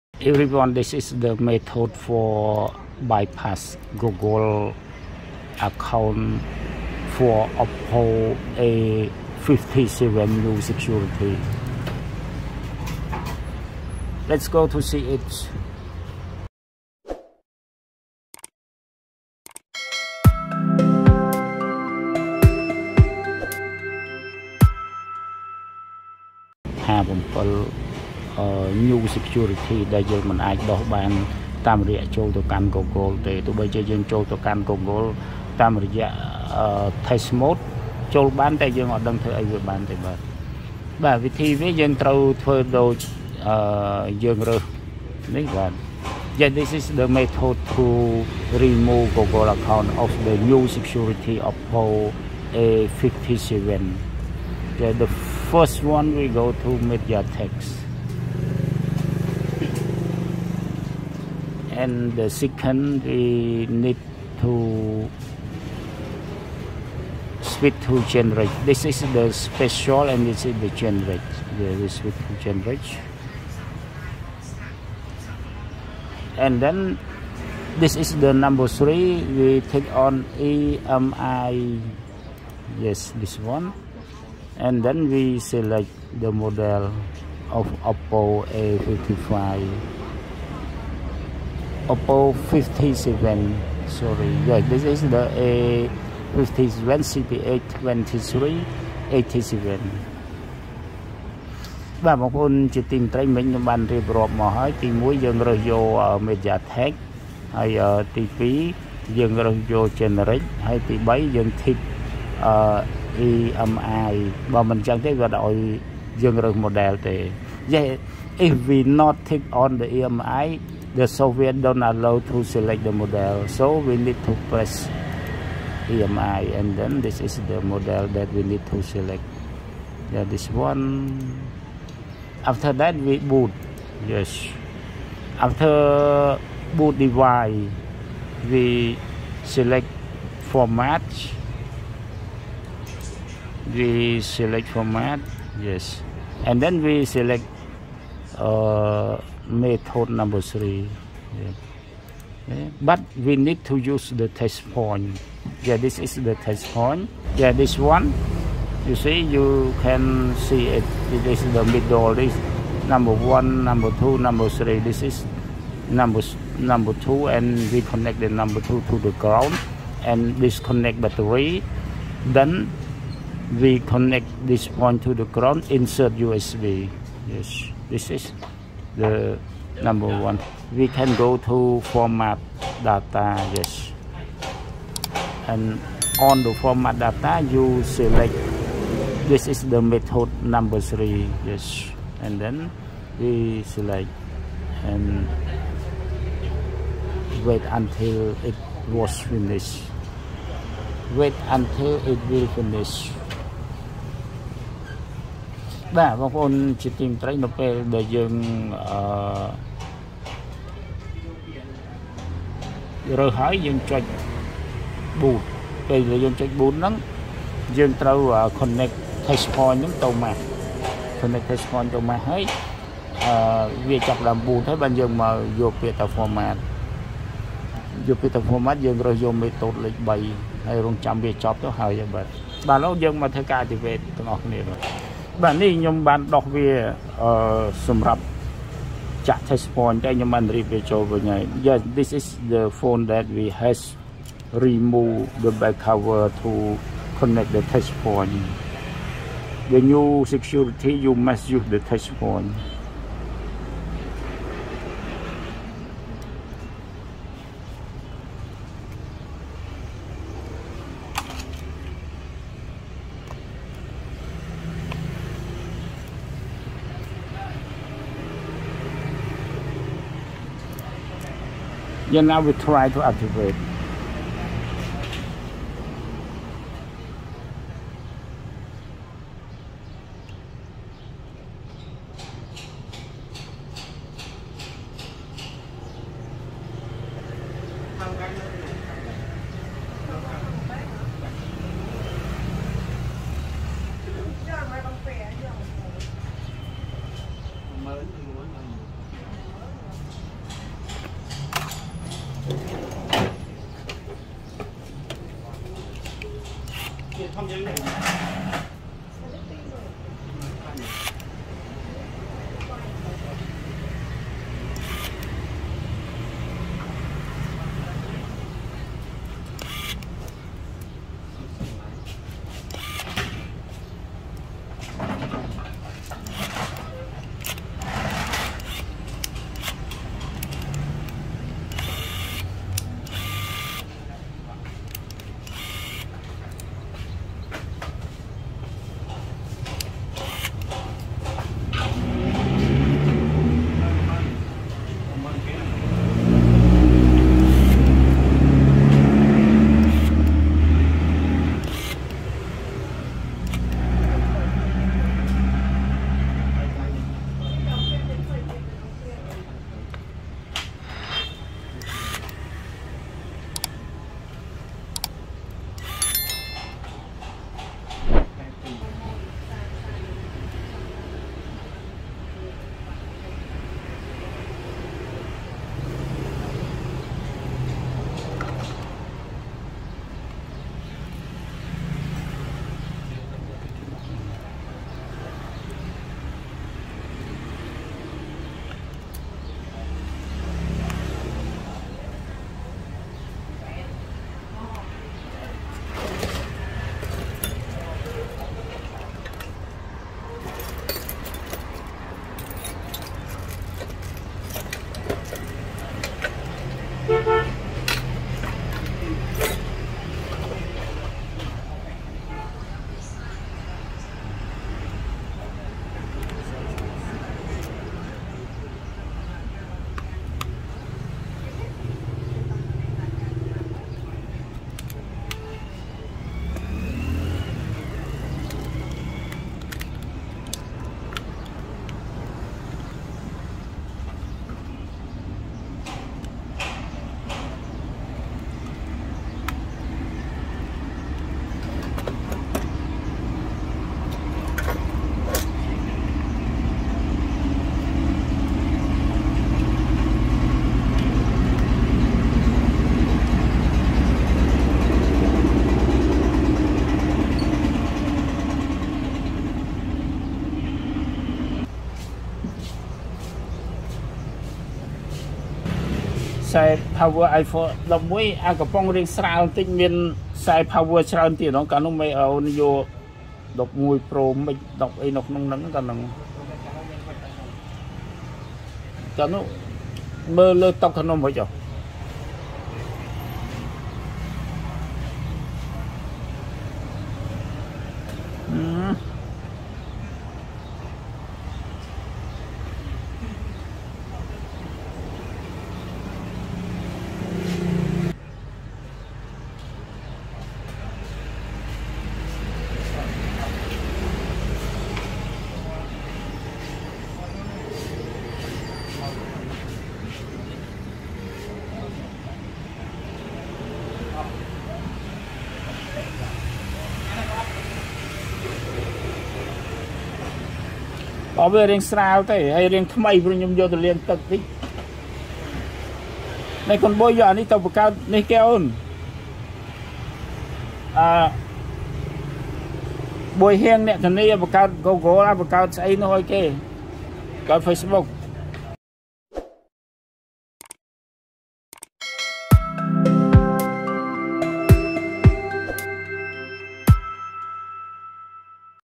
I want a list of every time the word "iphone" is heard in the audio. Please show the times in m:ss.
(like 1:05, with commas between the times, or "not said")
7:47.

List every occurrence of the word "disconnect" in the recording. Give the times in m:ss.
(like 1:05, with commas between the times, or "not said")
2:50.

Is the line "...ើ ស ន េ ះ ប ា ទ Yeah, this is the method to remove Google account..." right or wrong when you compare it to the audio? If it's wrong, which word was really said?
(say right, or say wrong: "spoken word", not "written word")
right.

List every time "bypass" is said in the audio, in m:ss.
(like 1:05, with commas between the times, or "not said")
0:03.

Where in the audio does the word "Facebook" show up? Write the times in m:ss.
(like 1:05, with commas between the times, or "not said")
8:57.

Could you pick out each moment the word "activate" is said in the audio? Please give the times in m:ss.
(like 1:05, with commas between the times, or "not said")
3:53, 4:33.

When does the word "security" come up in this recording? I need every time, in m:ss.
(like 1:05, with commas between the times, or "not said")
0:10, 0:29, 0:50, 4:10.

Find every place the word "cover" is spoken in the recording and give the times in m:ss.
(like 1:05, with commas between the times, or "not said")
4:05.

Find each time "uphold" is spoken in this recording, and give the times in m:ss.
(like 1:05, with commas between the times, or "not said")
0:07.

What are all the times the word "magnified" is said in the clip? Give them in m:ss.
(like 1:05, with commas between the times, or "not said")
not said.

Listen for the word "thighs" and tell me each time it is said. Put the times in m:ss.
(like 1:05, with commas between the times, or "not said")
not said.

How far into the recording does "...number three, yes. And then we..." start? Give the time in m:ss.
3:10.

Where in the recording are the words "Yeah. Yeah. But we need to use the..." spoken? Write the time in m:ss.
2:31.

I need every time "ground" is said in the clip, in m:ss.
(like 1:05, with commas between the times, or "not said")
2:49, 2:55.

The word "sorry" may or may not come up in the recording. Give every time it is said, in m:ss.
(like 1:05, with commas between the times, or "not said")
1:33.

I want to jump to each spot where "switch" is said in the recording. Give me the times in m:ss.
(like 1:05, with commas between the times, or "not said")
1:07, 1:11.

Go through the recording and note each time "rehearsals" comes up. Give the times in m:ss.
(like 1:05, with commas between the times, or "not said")
not said.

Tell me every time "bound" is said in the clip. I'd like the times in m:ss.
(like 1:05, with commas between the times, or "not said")
not said.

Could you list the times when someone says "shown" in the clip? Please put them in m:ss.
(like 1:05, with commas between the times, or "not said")
not said.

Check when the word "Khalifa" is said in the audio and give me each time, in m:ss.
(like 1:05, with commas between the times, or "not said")
not said.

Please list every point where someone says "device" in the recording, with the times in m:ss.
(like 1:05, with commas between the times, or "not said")
2:16.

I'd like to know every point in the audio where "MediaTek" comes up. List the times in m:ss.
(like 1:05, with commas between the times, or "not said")
0:56, 1:46.